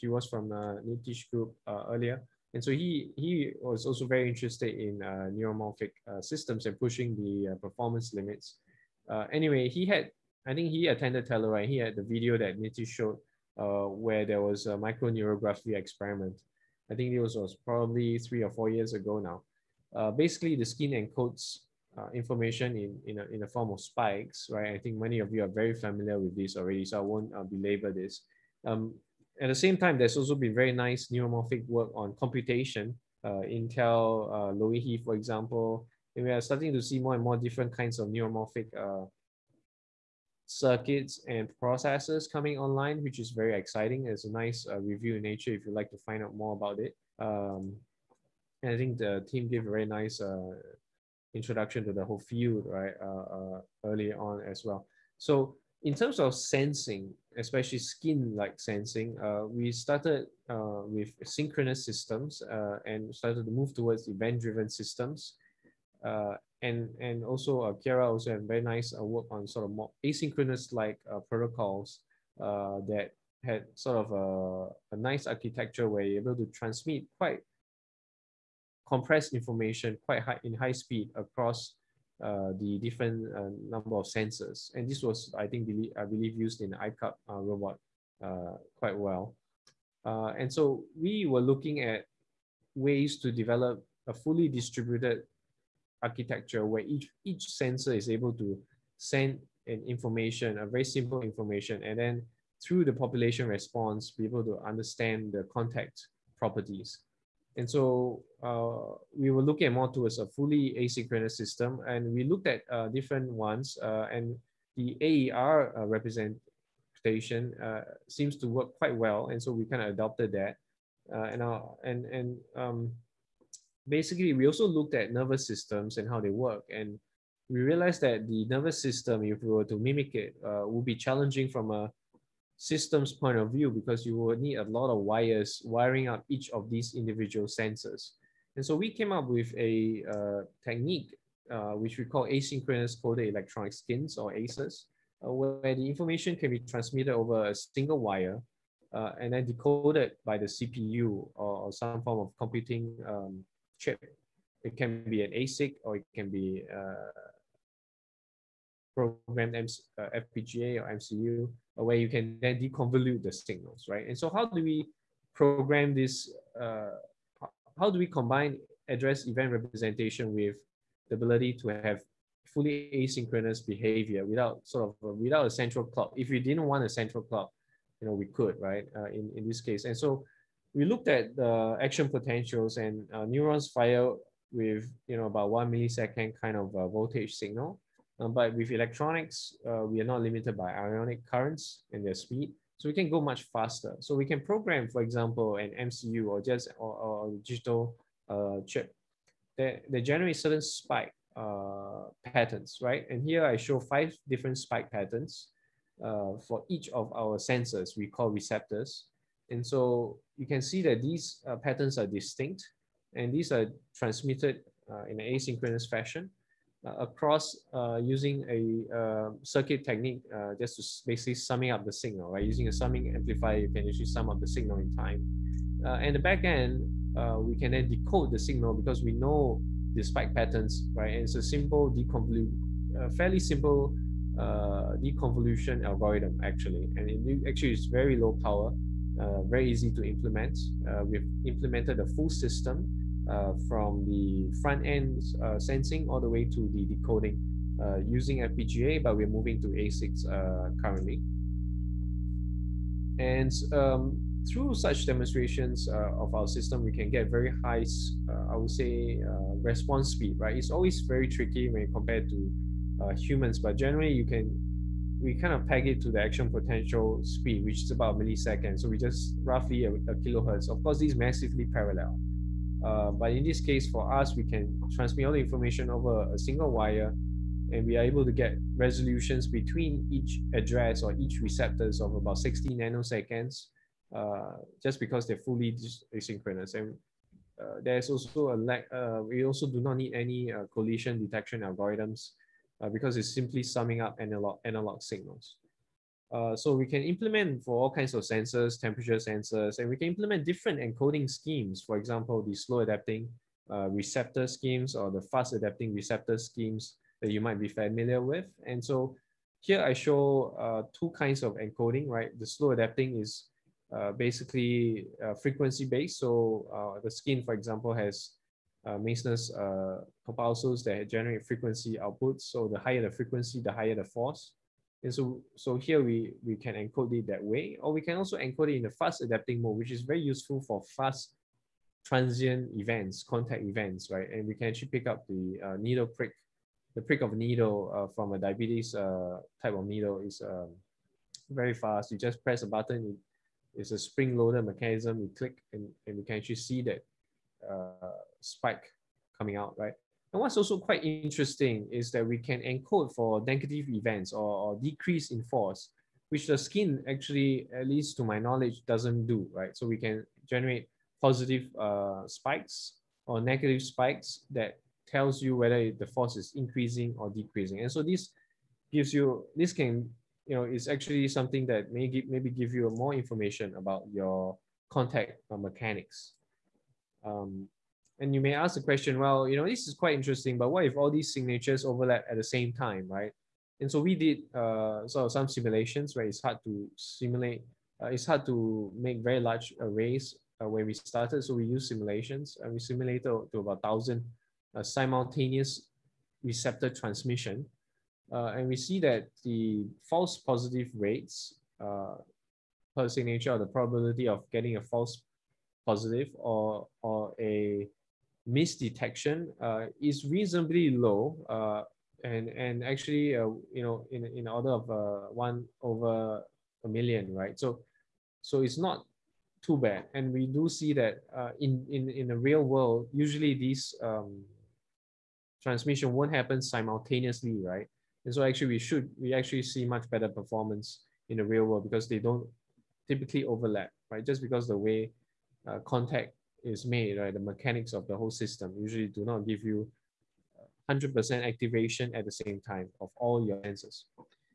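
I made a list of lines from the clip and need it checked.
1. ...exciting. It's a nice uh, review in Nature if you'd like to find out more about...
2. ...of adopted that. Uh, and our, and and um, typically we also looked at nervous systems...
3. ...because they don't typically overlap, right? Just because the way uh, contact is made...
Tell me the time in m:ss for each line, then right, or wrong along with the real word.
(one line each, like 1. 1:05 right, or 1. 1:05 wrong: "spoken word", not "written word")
1. 0:43 right
2. 1:59 wrong: "basically", not "typically"
3. 7:11 right.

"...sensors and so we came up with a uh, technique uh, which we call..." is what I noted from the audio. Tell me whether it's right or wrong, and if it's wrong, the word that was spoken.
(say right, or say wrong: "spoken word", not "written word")
right.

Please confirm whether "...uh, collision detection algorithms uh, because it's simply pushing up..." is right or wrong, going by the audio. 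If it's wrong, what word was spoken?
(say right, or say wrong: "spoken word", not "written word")
wrong: "summing", not "pushing".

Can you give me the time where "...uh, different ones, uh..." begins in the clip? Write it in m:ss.
1:52.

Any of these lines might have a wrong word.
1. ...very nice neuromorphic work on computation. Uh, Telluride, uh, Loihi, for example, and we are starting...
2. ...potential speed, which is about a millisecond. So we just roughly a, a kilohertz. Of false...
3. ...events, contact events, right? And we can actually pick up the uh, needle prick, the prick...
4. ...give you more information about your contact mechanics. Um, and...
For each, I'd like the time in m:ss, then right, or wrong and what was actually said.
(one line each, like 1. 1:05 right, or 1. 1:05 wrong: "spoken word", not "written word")
1. 0:30 wrong: "Intel", not "Telluride"
2. 4:26 wrong: "course", not "false"
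3. 5:32 right
4. 6:12 right.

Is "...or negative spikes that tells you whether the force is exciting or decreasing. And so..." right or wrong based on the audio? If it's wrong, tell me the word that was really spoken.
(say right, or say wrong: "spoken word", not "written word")
wrong: "increasing", not "exciting".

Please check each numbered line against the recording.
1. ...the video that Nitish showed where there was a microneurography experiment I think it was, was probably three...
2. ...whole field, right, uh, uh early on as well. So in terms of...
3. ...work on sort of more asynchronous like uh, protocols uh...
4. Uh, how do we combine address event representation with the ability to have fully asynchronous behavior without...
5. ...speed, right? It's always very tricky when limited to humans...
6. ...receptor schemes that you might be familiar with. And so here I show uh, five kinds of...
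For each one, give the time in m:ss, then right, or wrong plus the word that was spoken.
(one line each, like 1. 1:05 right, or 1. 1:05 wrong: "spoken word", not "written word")
1. 0:11 right
2. 0:52 right
3. 1:09 right
4. 2:46 right
5. 4:20 wrong: "compared", not "limited"
6. 5:05 wrong: "two", not "five".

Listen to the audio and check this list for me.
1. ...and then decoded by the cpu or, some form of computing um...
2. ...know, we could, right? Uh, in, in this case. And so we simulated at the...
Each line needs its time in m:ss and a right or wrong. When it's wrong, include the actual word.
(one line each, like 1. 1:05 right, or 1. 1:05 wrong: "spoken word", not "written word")
1. 2:29 right
2. 2:58 wrong: "looked", not "simulated".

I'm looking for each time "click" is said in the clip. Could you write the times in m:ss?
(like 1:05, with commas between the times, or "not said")
5:45.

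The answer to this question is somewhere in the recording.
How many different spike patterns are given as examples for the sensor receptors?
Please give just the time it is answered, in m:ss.
3:23.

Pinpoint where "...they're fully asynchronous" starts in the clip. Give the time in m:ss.
4:45.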